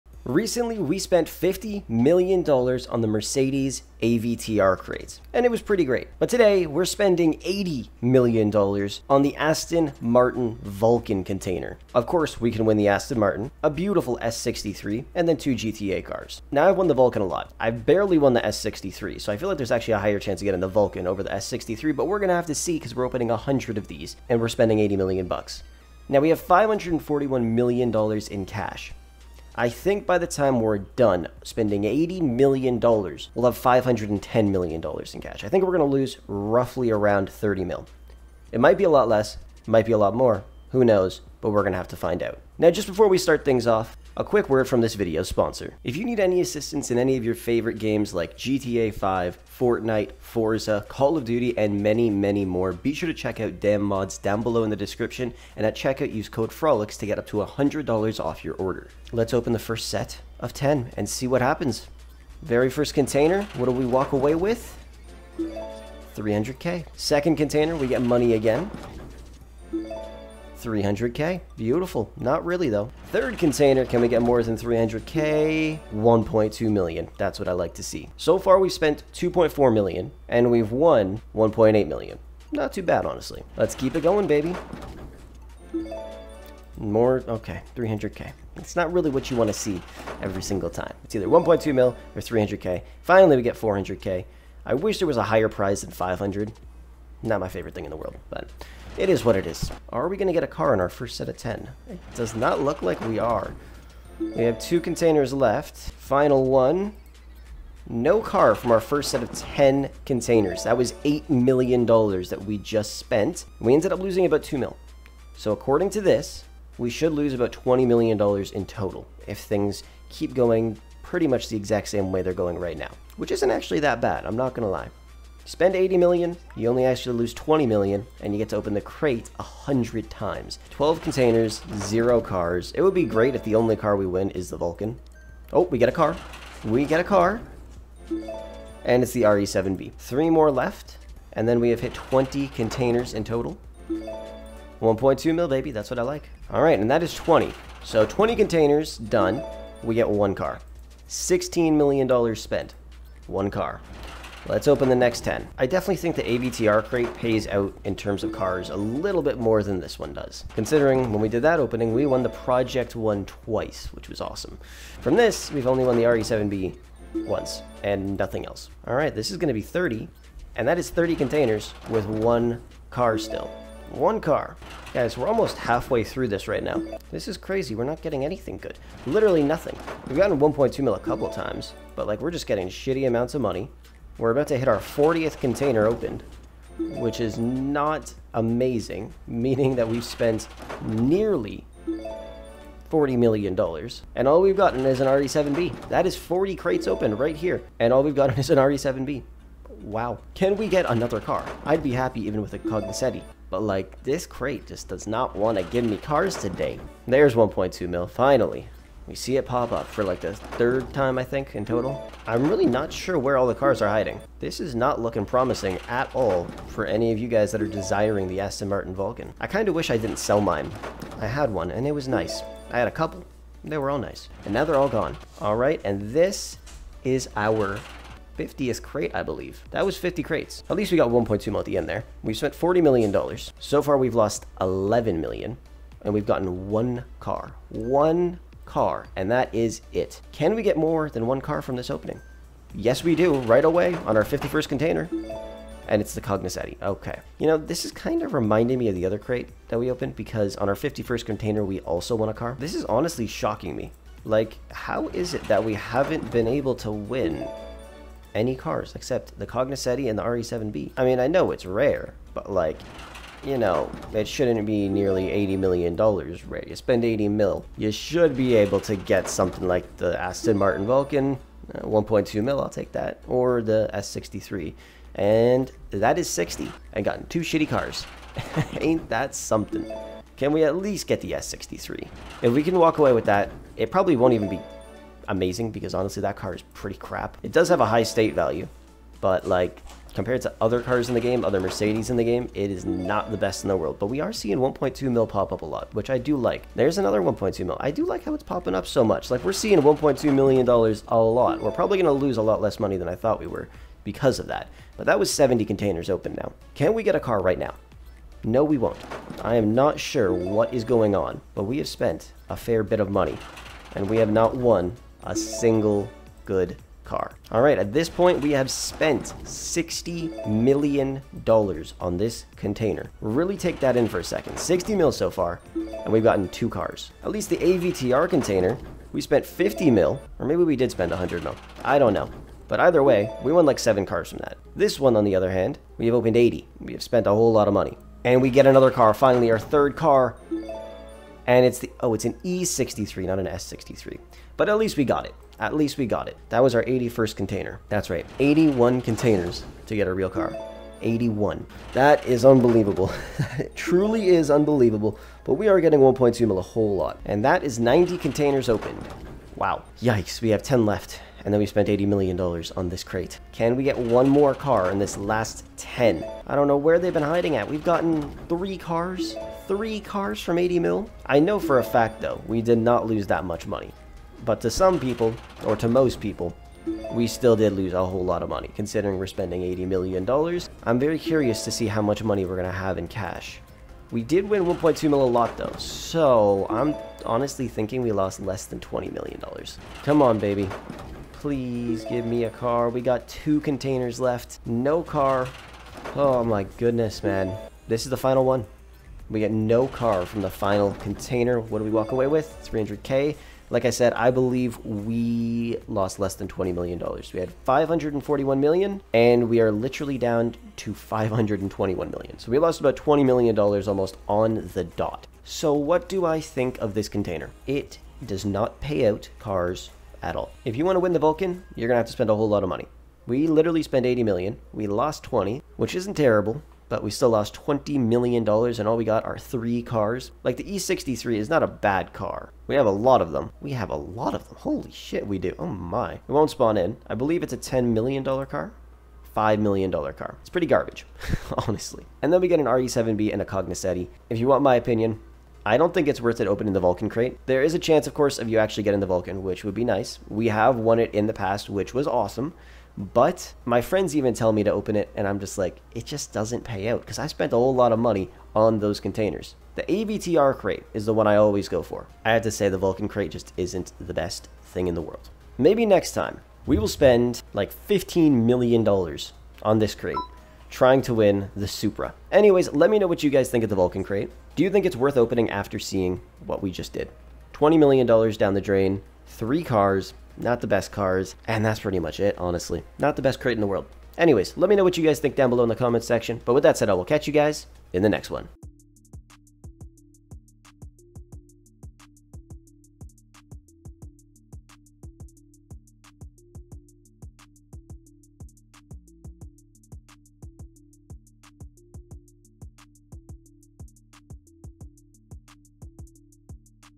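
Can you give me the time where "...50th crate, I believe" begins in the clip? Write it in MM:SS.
03:48.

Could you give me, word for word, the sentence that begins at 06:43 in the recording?
Like I said, I believe we lost less than $20 million.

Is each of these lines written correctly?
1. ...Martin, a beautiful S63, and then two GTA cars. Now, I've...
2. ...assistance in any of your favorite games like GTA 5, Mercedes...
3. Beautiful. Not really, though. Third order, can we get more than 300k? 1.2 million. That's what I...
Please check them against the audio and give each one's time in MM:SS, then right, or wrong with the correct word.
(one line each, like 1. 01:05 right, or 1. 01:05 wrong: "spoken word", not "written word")
1. 00:13 right
2. 00:46 wrong: "Fortnite", not "Mercedes"
3. 01:11 wrong: "container", not "order".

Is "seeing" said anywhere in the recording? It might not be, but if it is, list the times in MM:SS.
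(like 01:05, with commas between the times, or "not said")
04:54, 04:59, 07:55.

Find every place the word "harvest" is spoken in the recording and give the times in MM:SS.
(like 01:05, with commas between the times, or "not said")
not said.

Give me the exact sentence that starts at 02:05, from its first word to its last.
Spend 80 million, you only actually lose 20 million, and you get to open the crate 100 times.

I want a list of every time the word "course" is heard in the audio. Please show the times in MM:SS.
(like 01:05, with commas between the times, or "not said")
00:12, 07:28.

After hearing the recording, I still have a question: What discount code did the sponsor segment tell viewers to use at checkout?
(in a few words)
FROLICKZ.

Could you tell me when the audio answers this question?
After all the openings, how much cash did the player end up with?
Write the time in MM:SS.
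06:50.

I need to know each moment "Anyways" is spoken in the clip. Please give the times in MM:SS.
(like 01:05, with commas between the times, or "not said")
07:52, 08:04.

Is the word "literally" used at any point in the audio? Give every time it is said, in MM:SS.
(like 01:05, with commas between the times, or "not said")
02:59, 06:49, 07:03.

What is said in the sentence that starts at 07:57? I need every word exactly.
$20 million down the drain, three cars, not the best cars, and that's pretty much it, honestly.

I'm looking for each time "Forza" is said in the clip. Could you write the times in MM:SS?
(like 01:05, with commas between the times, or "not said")
00:50.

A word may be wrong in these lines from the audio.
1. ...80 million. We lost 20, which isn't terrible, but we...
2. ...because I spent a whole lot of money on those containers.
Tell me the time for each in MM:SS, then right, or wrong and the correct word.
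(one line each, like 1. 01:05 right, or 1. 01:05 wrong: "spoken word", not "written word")
1. 07:04 right
2. 07:37 right.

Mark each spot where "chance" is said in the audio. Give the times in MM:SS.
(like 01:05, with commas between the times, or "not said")
00:20, 07:27.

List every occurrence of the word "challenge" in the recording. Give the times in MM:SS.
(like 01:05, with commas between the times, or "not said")
not said.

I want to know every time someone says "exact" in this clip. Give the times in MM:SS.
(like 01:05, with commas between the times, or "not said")
02:01.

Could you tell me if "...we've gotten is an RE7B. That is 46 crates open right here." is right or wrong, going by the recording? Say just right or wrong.
wrong.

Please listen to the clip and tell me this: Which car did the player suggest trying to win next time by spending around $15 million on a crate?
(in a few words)
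Supra.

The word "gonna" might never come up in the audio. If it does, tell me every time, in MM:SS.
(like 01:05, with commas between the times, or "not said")
00:22, 02:49, 05:01.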